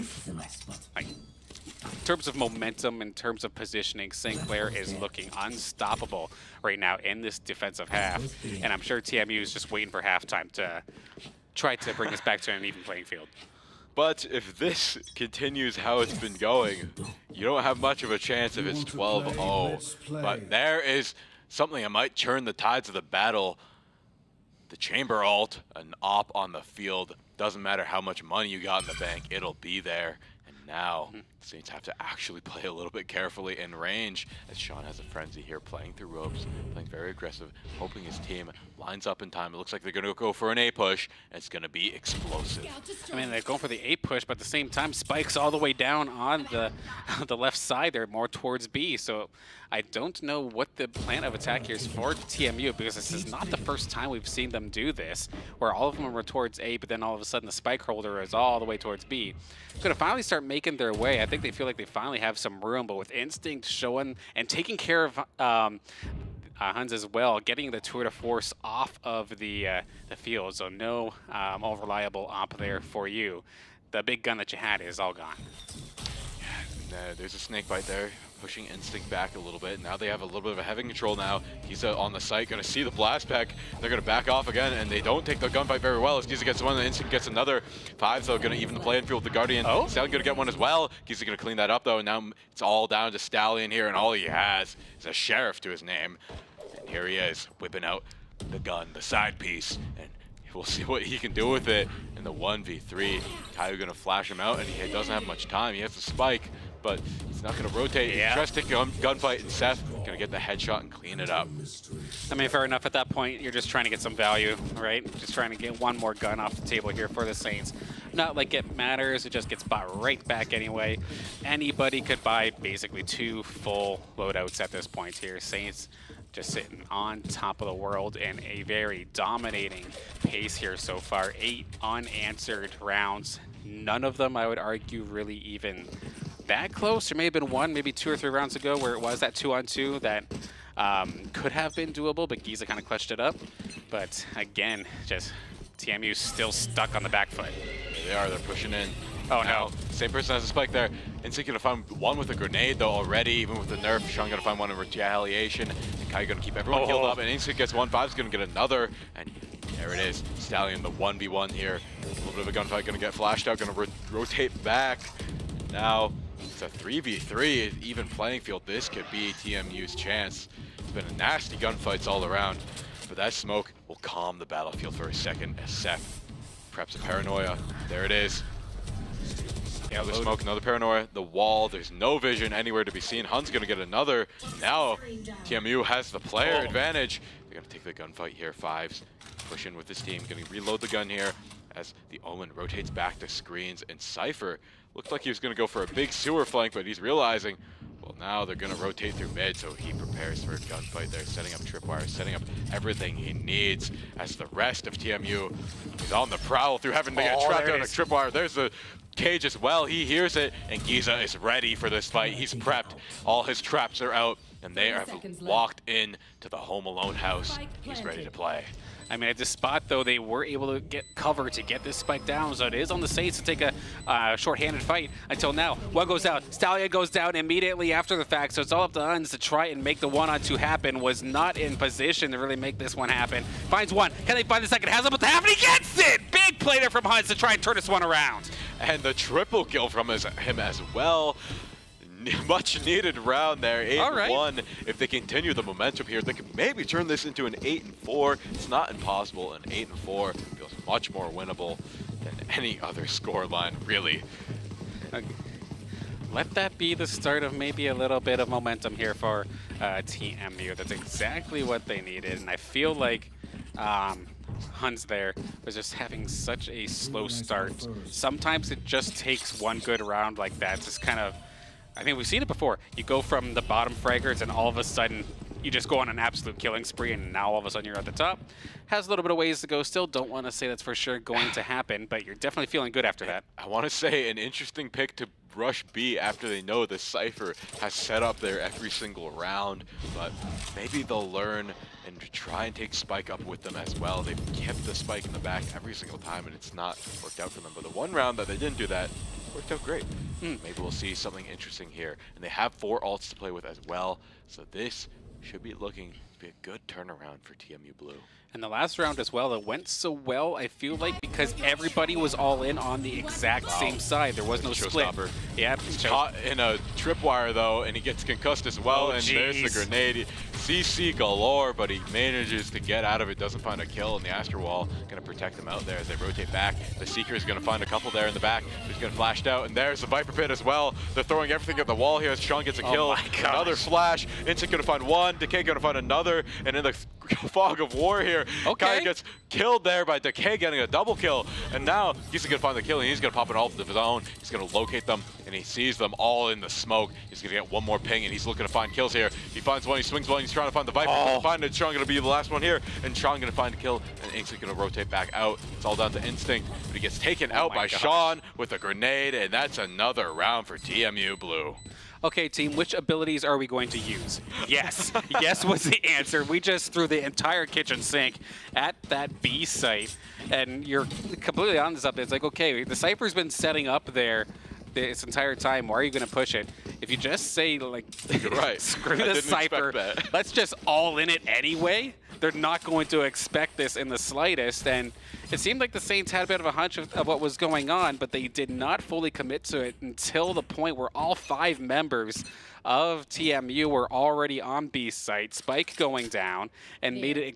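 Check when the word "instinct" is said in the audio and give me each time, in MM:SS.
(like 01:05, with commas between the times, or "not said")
01:03, 01:18, 01:26, 02:31, 02:37, 05:34, 05:56.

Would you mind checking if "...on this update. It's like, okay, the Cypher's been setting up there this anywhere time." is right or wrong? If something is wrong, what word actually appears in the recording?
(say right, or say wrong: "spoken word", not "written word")
wrong: "entire", not "anywhere".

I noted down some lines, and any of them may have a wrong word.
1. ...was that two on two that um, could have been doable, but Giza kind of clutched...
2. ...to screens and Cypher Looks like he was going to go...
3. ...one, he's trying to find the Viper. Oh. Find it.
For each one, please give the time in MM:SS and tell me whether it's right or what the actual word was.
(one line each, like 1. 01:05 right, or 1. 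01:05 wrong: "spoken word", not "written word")
1. 02:18 right
2. 03:13 right
3. 05:50 right.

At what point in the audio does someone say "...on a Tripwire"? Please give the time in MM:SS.
03:27.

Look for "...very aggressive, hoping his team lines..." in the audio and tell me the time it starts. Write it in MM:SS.
00:36.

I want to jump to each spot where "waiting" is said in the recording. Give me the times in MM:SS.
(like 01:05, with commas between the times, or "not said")
00:09.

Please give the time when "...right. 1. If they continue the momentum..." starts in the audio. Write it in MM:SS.
04:04.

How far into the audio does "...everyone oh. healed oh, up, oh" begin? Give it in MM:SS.
02:36.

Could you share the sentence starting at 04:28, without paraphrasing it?
Sometimes it just takes one good round like that, just kind of I mean, we've seen it before.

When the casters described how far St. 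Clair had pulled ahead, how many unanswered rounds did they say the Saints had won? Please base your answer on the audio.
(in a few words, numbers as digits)
8.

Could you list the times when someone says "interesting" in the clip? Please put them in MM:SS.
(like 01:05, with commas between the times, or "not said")
04:44, 05:01.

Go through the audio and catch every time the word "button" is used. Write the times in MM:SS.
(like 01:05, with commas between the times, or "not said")
not said.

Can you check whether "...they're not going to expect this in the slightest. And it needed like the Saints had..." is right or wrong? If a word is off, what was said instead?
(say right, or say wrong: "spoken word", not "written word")
wrong: "seemed", not "needed".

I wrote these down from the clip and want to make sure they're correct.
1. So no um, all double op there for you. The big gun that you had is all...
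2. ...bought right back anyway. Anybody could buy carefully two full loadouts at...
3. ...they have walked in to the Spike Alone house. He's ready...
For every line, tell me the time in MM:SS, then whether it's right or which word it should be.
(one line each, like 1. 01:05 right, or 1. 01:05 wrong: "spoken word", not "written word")
1. 01:10 wrong: "reliable", not "double"
2. 01:59 wrong: "basically", not "carefully"
3. 03:34 wrong: "Home", not "Spike".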